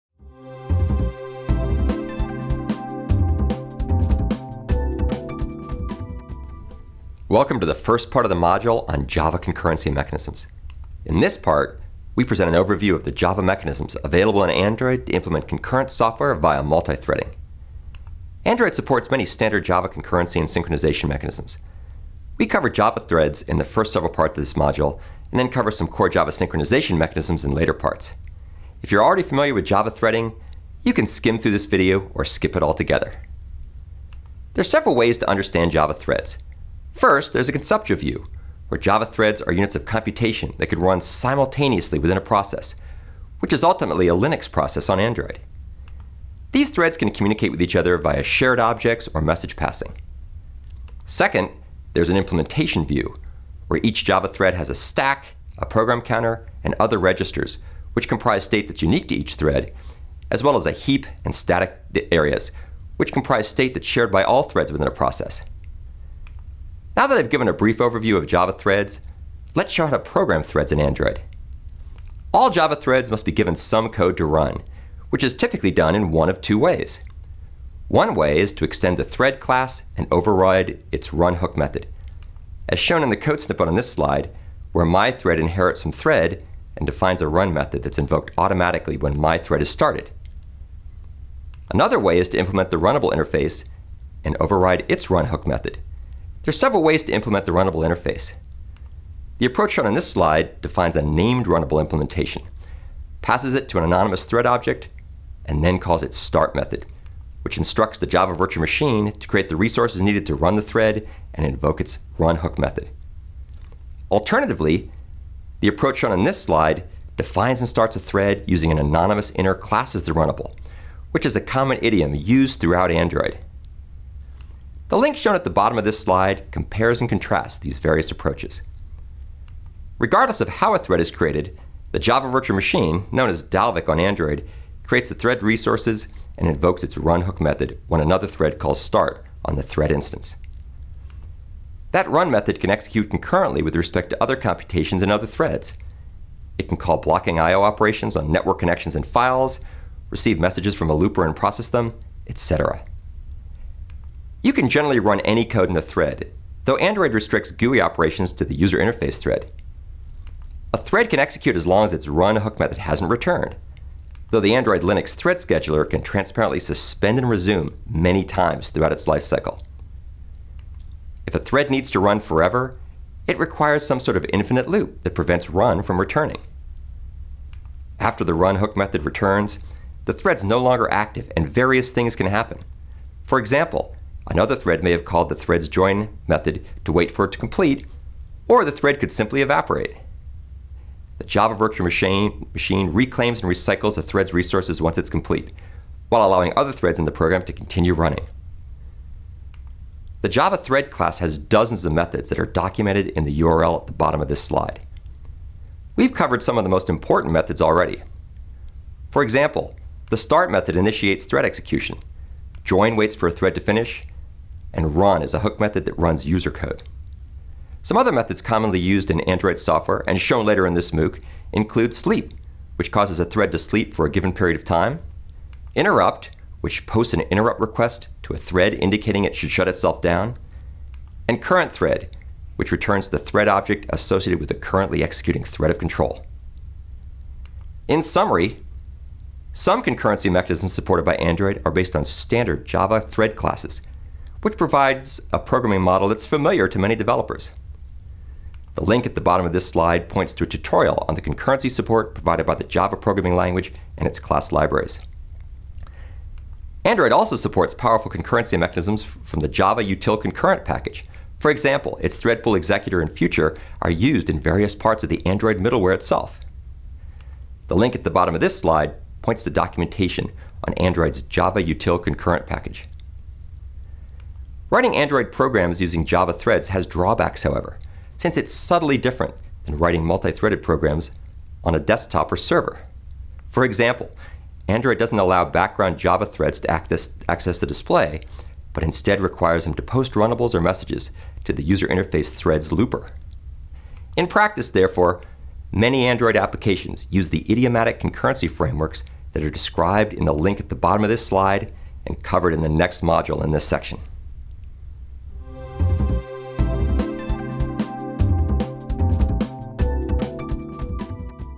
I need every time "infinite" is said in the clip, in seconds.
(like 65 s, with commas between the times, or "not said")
174 s.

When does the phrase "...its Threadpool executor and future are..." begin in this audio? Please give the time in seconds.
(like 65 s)
262 s.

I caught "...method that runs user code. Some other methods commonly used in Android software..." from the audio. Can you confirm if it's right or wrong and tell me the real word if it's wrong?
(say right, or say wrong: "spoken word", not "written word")
right.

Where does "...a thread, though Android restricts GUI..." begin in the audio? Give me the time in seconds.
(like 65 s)
155 s.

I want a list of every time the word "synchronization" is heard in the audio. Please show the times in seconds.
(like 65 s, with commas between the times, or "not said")
20 s, 26 s.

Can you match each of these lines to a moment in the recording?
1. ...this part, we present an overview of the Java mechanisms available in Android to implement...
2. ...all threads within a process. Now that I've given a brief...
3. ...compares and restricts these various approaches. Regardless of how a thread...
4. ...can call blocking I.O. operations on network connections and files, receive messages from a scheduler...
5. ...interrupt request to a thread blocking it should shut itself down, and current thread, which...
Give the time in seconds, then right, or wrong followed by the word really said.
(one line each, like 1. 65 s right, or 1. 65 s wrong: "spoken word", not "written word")
1. 11 s right
2. 64 s right
3. 126 s wrong: "contrasts", not "restricts"
4. 146 s wrong: "looper", not "scheduler"
5. 227 s wrong: "indicating", not "blocking".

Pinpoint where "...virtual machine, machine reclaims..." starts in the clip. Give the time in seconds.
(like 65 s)
191 s.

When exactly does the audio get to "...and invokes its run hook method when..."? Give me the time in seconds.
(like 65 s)
136 s.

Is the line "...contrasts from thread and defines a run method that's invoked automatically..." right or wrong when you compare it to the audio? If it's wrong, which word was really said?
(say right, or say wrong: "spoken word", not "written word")
wrong: "inherits", not "contrasts".